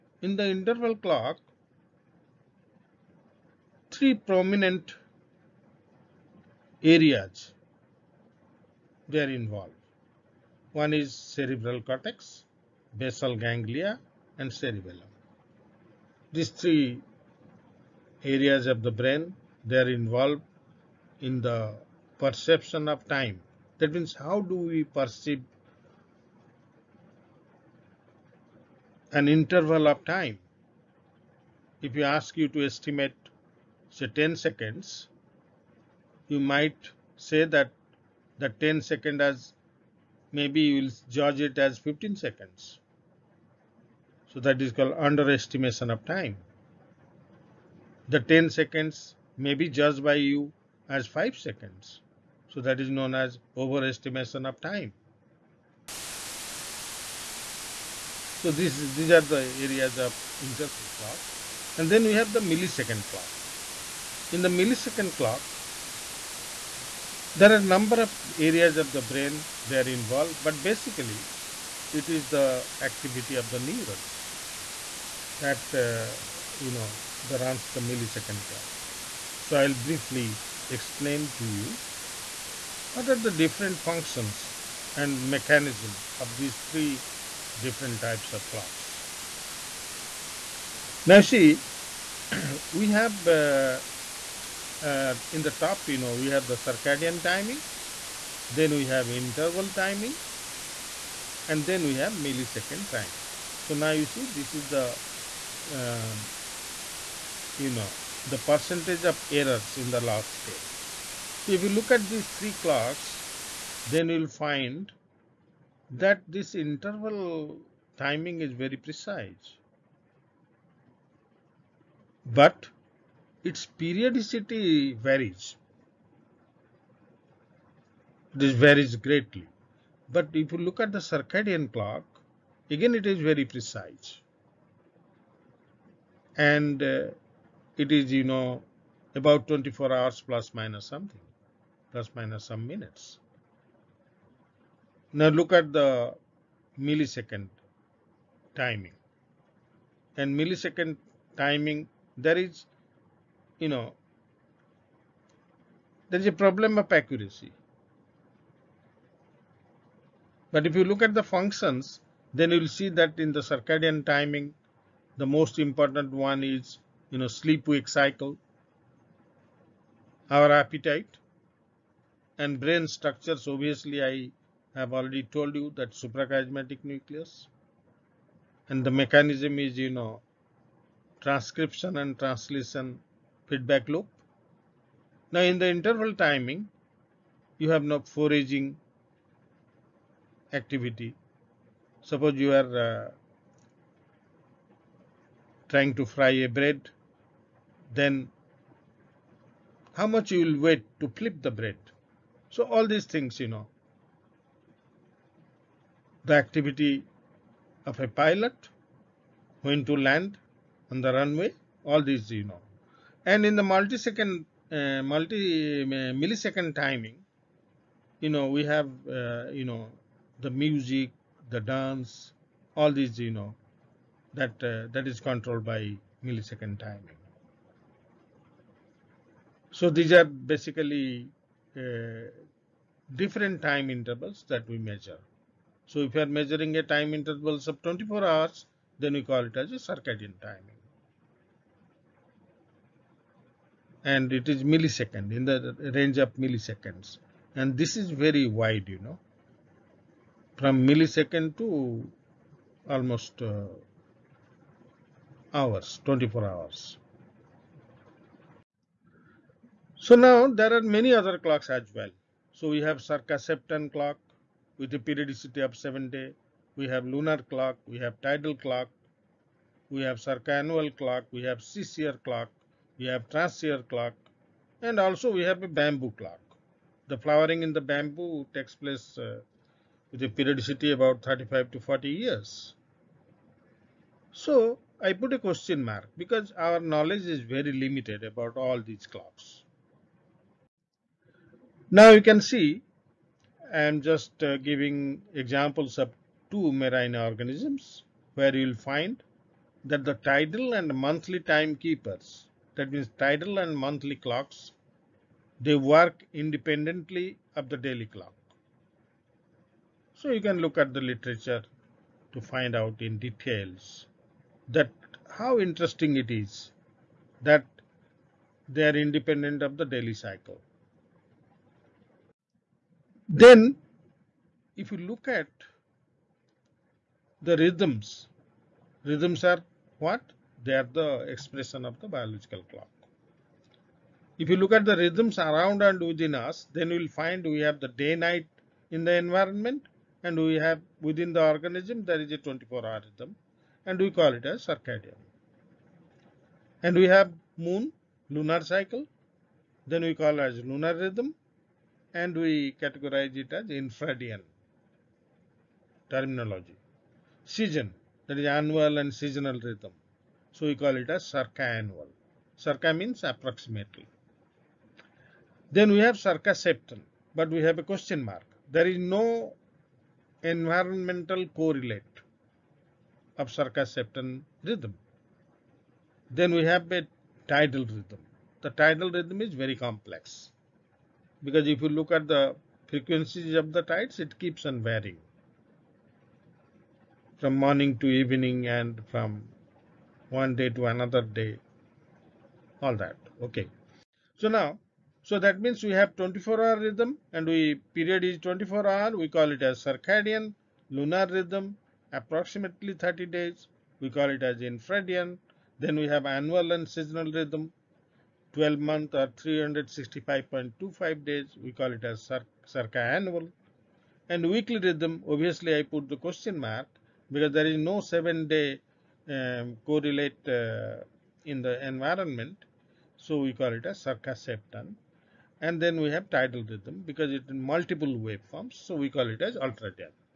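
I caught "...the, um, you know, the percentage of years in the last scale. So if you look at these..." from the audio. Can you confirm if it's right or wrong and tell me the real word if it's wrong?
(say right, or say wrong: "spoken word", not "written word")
wrong: "errors", not "years".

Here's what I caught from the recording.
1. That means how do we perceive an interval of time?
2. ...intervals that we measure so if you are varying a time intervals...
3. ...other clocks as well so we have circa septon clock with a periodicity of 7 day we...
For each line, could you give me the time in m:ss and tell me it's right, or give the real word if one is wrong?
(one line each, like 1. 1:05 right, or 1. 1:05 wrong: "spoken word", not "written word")
1. 0:23 right
2. 3:53 wrong: "measuring", not "varying"
3. 4:21 right.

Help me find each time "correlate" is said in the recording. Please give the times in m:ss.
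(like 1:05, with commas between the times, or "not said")
6:11, 6:59.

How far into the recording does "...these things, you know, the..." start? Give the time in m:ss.
3:22.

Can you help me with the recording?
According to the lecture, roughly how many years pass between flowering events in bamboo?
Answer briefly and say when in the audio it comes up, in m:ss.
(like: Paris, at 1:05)
35 to 40 years, at 4:41.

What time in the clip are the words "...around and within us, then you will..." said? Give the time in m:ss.
5:35.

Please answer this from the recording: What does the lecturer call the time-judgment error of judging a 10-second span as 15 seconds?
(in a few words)
underestimation of time.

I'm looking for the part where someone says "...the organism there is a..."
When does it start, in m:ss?
5:41.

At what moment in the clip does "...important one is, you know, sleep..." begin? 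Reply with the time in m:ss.
2:45.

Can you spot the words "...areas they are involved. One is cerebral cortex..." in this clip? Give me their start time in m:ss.
0:06.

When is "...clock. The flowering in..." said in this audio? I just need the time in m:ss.
4:36.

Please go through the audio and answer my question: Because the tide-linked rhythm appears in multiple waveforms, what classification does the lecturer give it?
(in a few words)
ultradian.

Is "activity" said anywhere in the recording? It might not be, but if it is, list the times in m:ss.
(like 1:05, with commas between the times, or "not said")
1:12, 3:10, 3:26.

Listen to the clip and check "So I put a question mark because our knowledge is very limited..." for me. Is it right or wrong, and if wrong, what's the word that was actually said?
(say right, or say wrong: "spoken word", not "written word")
right.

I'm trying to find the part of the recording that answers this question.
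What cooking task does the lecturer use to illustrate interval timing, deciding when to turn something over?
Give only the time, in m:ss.
3:16.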